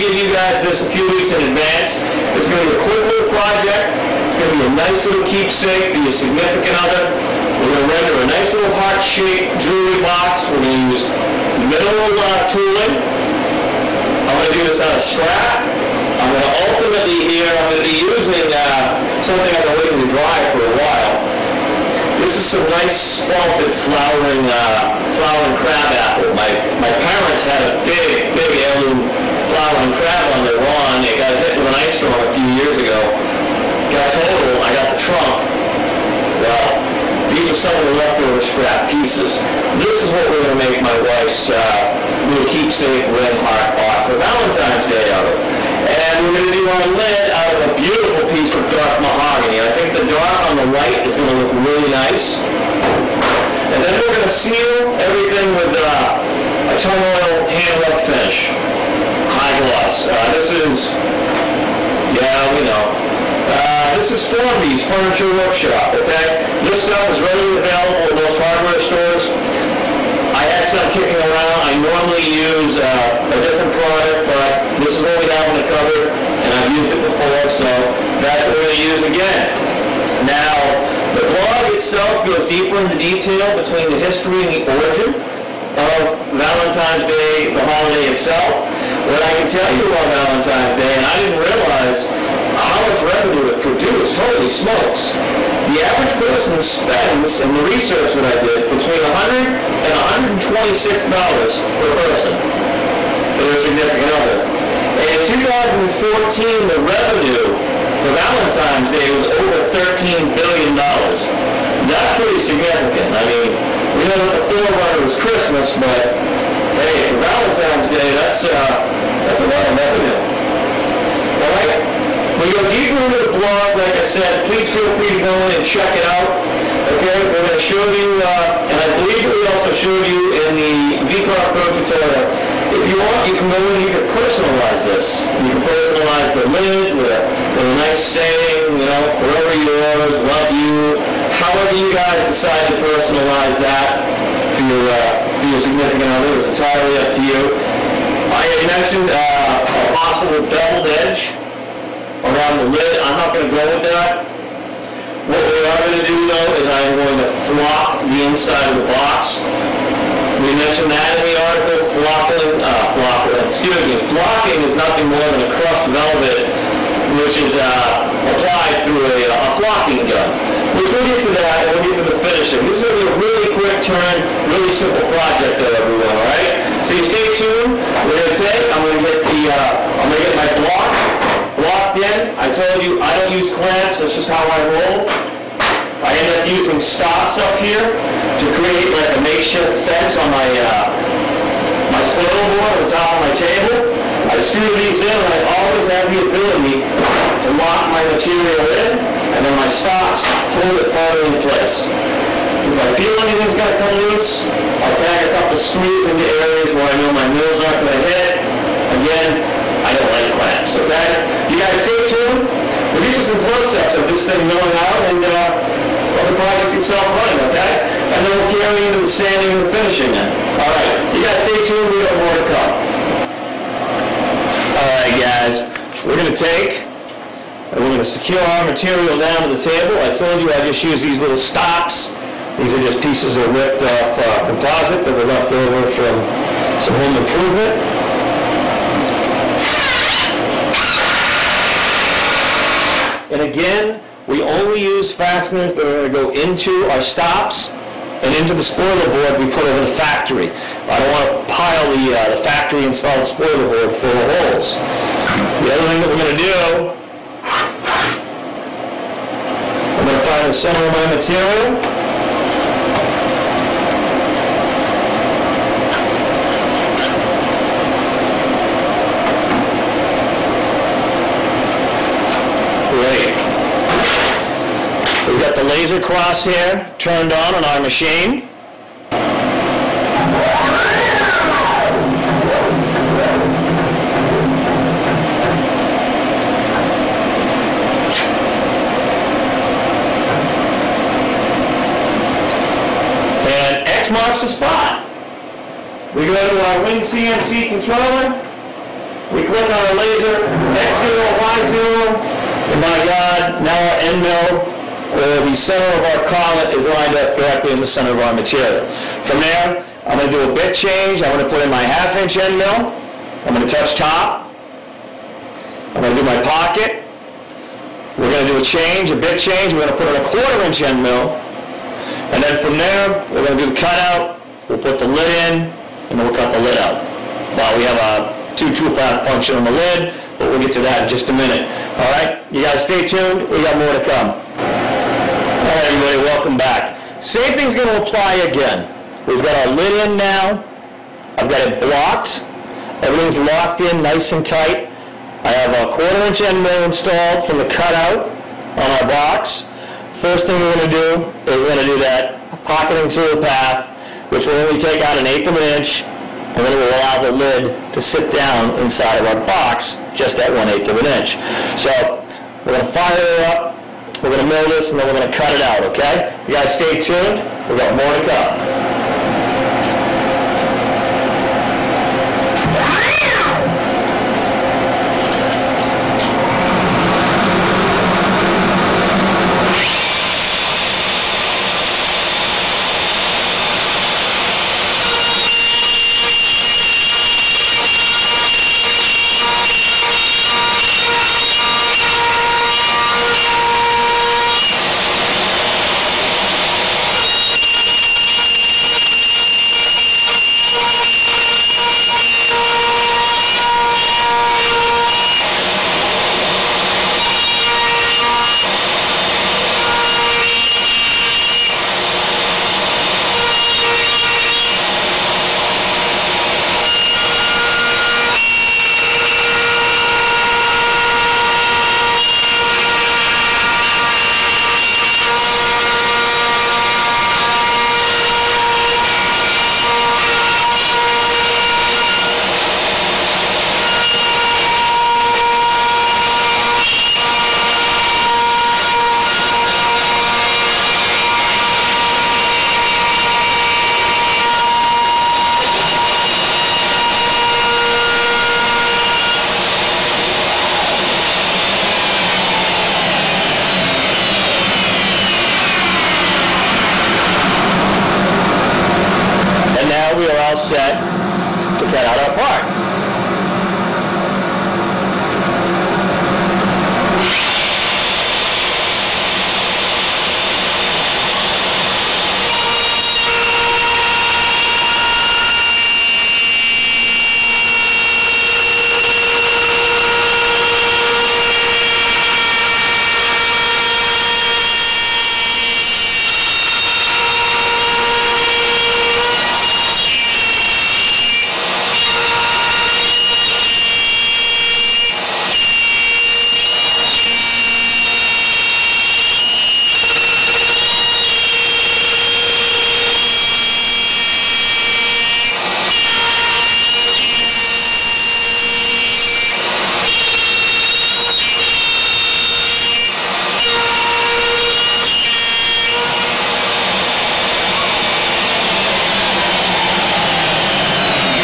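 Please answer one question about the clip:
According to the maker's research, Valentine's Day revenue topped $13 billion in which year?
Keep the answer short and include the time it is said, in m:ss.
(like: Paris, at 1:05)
2014, at 1:45.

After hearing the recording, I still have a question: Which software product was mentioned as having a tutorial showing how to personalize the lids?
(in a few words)
VCarve Pro.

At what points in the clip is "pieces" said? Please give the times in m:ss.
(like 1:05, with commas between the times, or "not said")
0:38, 0:48, 3:53.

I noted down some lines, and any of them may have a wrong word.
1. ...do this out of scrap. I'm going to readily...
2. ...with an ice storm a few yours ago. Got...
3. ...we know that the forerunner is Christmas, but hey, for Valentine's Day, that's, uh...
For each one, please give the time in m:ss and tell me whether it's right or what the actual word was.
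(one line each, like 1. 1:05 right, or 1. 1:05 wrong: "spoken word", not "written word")
1. 0:14 wrong: "ultimately", not "readily"
2. 0:31 wrong: "years", not "yours"
3. 1:53 right.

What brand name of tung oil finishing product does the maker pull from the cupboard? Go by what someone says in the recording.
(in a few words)
Formby's.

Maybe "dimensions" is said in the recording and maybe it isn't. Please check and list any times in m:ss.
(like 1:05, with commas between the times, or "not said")
not said.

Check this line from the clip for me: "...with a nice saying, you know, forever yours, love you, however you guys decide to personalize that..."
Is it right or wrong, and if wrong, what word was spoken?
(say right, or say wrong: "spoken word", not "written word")
right.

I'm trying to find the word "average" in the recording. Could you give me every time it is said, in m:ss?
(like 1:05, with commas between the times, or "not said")
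1:35.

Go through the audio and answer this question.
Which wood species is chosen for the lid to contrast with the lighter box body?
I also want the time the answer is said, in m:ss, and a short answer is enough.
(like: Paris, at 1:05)
Mahogany, at 0:48.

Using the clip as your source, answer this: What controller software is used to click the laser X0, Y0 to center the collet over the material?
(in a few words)
WinCNC.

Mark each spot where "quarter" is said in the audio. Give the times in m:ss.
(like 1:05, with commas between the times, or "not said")
5:20, 5:45.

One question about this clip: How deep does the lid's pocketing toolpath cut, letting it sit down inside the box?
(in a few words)
1/8 inch.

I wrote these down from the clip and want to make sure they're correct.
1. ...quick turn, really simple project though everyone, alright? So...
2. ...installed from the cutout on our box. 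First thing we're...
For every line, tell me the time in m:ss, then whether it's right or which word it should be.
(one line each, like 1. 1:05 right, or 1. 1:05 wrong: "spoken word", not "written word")
1. 2:53 right
2. 5:46 right.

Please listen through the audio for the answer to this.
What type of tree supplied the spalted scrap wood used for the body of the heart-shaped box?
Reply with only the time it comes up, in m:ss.
0:25.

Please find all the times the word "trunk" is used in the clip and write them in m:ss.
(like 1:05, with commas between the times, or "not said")
0:34.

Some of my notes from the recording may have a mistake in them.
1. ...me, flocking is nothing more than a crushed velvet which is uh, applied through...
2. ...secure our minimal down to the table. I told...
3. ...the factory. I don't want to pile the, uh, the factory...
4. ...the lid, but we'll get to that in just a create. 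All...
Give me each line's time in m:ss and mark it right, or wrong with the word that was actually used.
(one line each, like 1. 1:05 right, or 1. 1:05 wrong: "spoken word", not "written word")
1. 2:43 right
2. 3:48 wrong: "material", not "minimal"
3. 4:09 right
4. 5:29 wrong: "minute", not "create".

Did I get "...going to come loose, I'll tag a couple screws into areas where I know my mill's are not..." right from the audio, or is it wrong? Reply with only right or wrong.
right.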